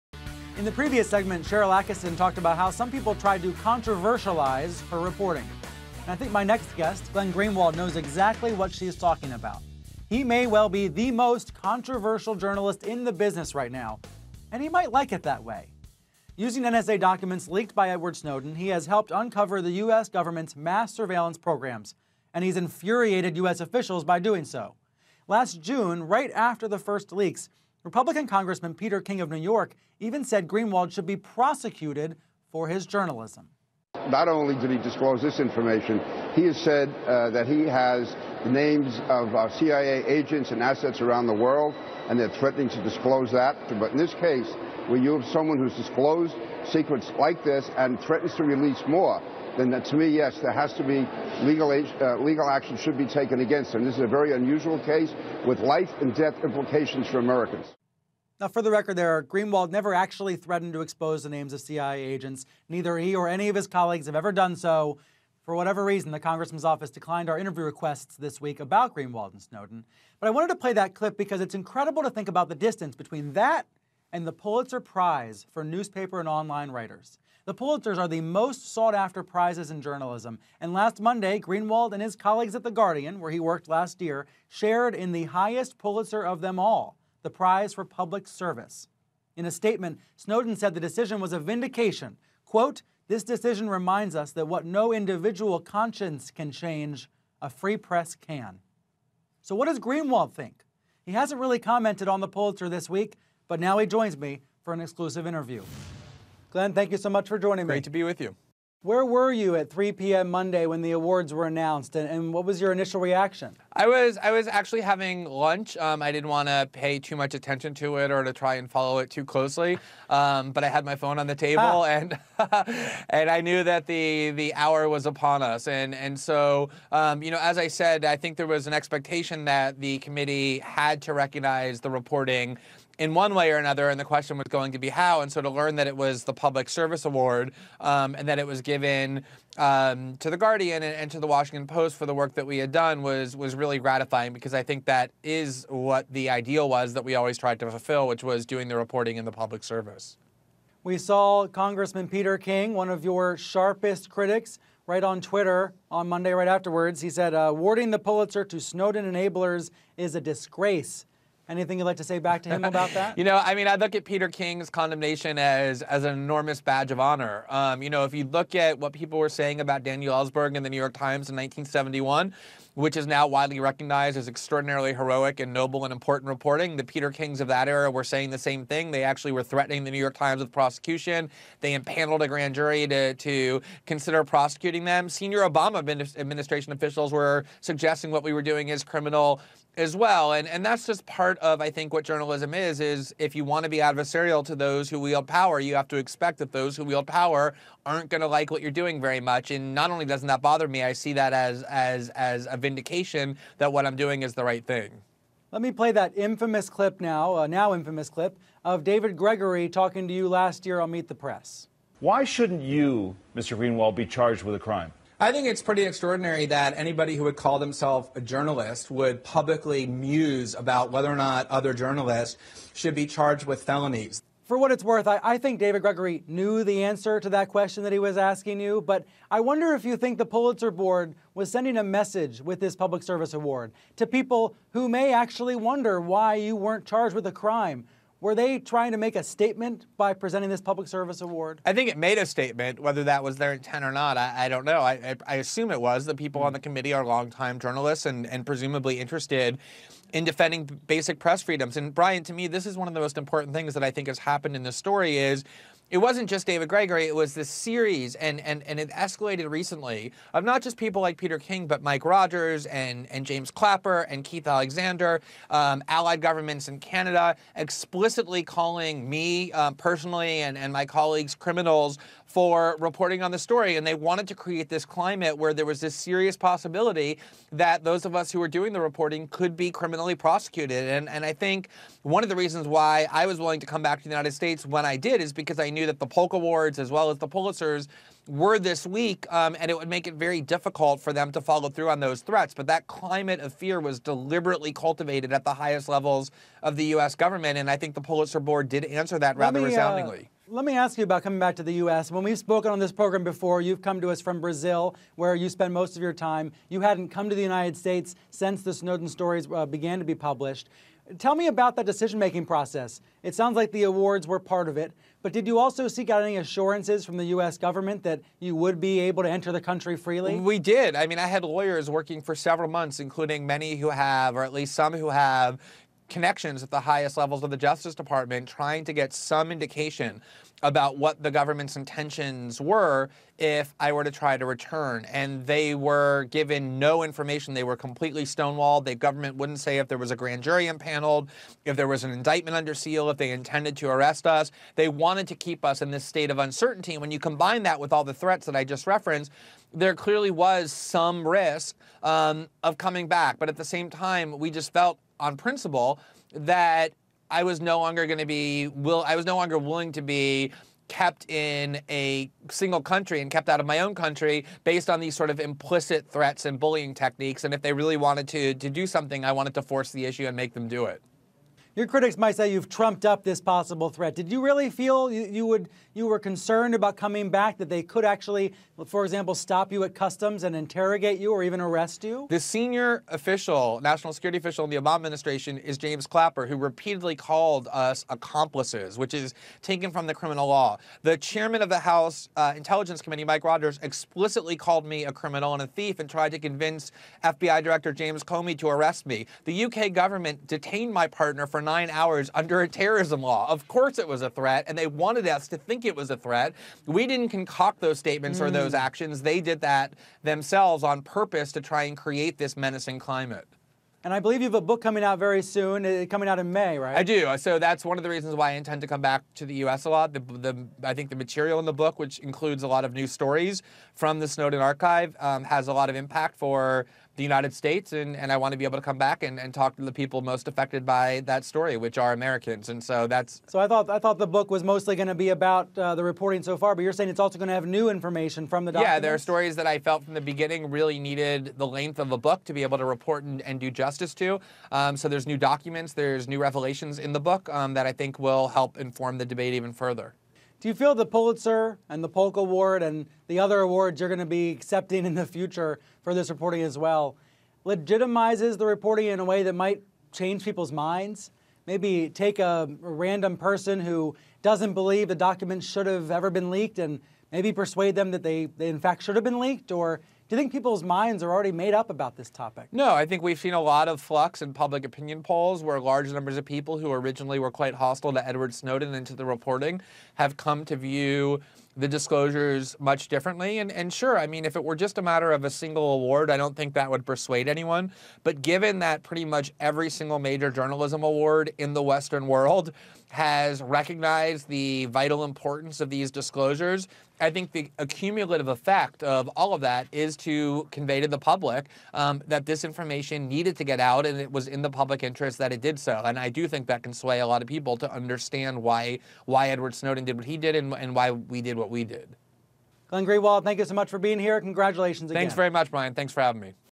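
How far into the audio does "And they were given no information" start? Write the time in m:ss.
5:35.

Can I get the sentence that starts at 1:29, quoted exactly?
In a statement, Snowden said the decision was a vindication.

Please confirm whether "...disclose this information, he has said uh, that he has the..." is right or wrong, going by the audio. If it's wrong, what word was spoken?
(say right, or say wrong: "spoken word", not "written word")
right.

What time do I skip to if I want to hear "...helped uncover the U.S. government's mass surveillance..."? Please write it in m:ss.
0:18.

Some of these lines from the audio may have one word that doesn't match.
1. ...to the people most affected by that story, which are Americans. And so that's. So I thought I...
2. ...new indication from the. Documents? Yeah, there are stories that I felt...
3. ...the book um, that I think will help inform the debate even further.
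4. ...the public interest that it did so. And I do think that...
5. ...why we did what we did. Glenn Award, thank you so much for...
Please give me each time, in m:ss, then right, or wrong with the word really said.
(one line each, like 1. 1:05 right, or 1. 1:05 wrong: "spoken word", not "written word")
1. 7:09 right
2. 7:17 wrong: "information", not "indication"
3. 7:27 right
4. 8:24 right
5. 8:30 wrong: "Greenwald", not "Award".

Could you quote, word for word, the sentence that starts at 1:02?
Neither he or any of his colleagues have ever done so.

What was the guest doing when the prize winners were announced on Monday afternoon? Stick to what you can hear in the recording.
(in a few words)
having lunch.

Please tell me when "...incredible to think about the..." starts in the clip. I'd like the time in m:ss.
1:11.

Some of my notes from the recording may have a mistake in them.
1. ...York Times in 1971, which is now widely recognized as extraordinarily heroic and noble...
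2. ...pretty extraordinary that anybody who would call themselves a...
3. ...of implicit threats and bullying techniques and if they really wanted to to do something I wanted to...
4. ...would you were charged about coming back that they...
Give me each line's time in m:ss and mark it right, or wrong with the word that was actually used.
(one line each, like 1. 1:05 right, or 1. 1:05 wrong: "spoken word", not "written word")
1. 2:50 right
2. 3:35 right
3. 6:05 right
4. 6:15 wrong: "concerned", not "charged".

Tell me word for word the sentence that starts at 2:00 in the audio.
Um, but I had my phone on the table ah.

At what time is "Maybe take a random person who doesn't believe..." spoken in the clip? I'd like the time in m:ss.
7:41.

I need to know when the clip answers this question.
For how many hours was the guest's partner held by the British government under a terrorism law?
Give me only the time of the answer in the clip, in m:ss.
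6:41.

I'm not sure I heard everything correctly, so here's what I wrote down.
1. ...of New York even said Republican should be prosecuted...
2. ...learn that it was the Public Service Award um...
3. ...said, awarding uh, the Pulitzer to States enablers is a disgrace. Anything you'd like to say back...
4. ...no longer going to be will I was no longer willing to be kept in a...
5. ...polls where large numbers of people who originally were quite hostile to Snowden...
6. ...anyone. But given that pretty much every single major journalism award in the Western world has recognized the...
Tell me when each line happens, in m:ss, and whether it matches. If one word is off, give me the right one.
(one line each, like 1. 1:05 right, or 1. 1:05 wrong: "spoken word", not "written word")
1. 0:29 wrong: "Greenwald", not "Republican"
2. 2:15 right
3. 2:37 wrong: "Snowden", not "States"
4. 5:57 right
5. 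7:55 wrong: "Edward", not "Snowden"
6. 8:07 right.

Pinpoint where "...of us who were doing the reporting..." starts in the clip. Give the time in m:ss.
4:38.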